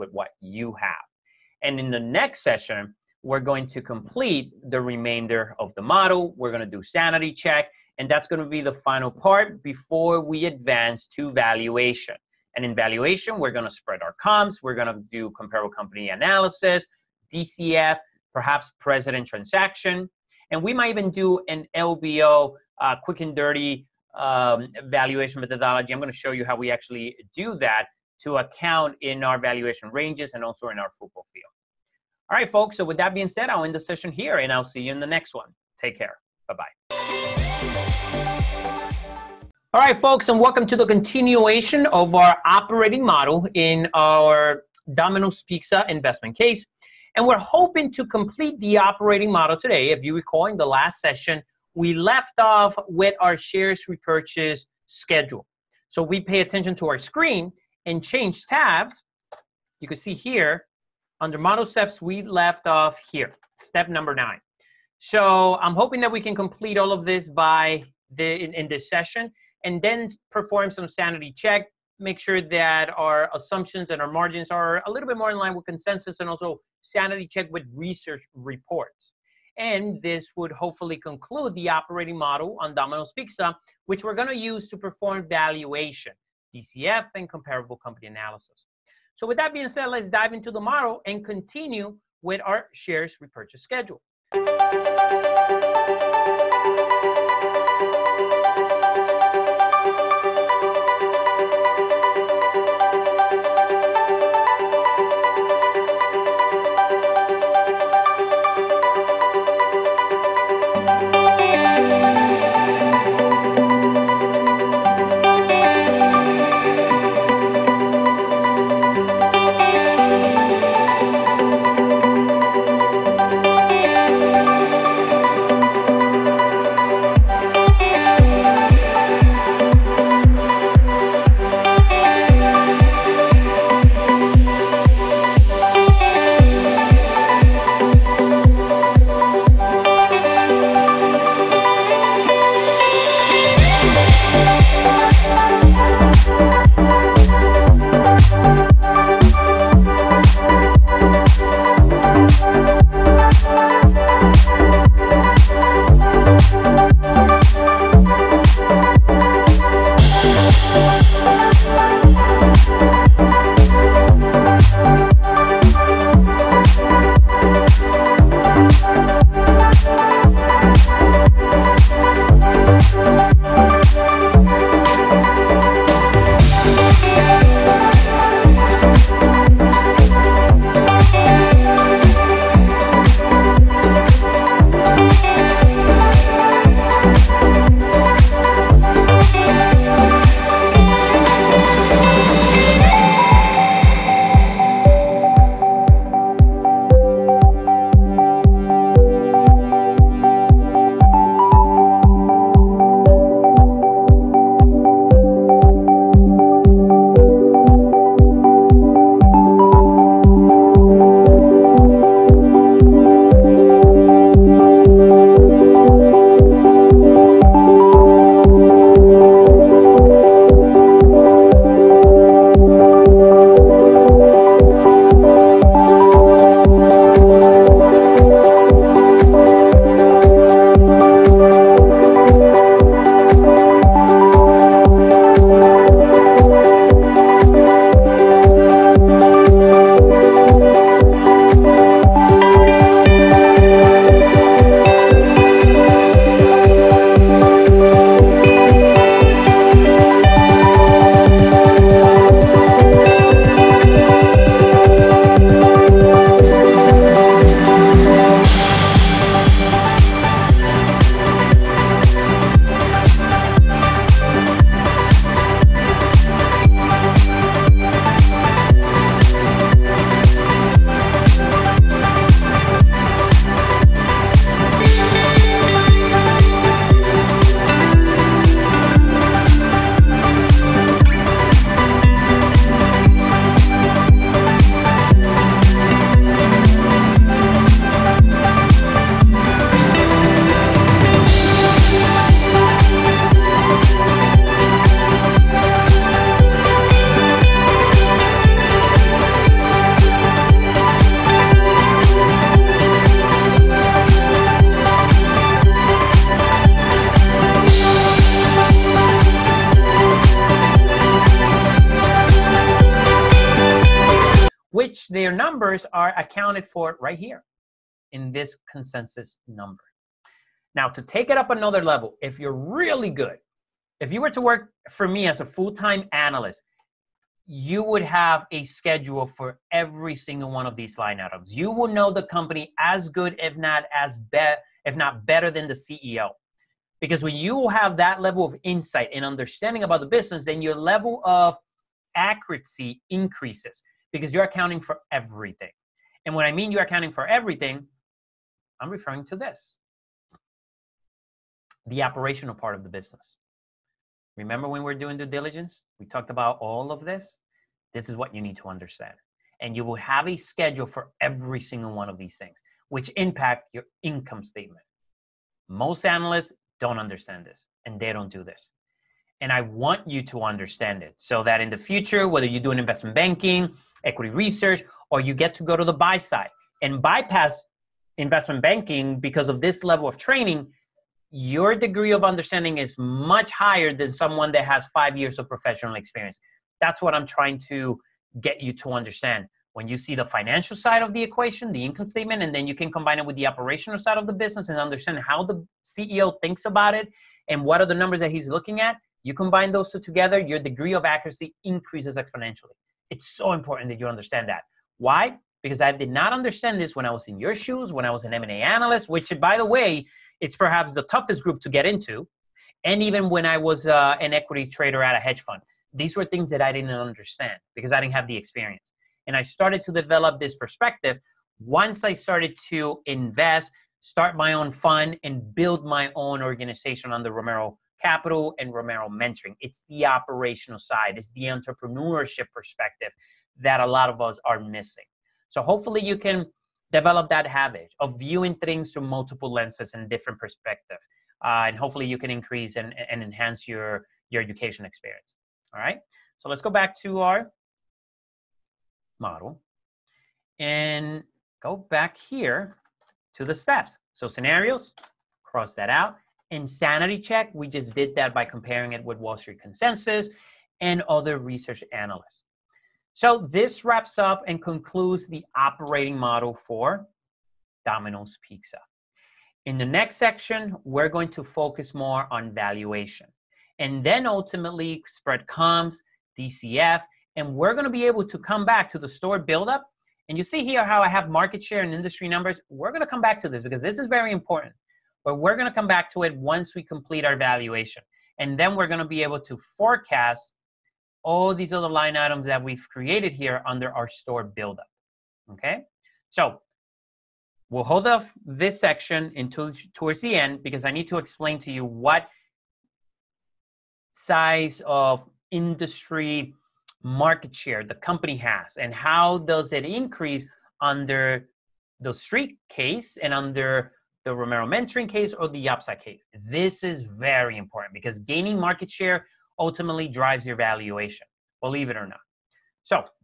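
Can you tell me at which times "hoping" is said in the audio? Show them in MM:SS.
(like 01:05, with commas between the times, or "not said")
00:47, 01:05.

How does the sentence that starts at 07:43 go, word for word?
So this wraps up and concludes the operating model for Domino's Pizza.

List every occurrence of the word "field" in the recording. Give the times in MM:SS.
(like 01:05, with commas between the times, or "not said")
00:31.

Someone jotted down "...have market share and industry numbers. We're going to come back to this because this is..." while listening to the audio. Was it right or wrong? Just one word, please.
right.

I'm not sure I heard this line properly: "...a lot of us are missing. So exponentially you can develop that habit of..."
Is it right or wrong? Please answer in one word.
wrong.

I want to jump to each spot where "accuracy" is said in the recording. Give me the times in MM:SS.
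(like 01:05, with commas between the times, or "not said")
05:42, 06:41.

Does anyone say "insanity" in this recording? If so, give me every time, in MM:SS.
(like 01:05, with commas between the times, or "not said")
07:36.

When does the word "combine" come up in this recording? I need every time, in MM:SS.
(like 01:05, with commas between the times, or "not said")
06:32, 06:39.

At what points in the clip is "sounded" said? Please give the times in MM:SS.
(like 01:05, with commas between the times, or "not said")
not said.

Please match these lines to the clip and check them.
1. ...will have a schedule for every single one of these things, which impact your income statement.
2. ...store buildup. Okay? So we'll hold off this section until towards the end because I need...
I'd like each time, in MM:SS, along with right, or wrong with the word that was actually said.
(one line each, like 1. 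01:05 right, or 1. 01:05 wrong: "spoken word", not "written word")
1. 05:59 right
2. 08:14 right.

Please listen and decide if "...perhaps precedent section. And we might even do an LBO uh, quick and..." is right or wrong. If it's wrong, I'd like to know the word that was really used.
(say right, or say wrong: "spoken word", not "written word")
wrong: "transaction", not "section".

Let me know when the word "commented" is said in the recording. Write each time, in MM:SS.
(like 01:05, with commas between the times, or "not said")
not said.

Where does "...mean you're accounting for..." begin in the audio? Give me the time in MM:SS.
05:46.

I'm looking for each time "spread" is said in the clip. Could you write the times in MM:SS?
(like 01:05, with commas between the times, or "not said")
00:13, 07:55.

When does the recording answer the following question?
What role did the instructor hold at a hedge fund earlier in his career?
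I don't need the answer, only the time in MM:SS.
06:54.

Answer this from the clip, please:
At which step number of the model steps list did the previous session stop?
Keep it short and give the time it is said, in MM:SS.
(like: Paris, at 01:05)
9, at 01:03.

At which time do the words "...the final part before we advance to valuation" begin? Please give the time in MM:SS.
00:08.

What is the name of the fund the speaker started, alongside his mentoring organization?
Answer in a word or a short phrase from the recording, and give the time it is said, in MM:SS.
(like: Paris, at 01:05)
Romero Capital, at 07:07.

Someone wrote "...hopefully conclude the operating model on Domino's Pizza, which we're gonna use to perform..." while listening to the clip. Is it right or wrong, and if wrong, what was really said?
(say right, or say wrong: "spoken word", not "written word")
right.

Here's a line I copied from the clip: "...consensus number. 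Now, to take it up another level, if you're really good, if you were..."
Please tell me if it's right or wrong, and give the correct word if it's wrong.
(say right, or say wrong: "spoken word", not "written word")
right.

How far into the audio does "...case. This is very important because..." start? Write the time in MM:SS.
08:35.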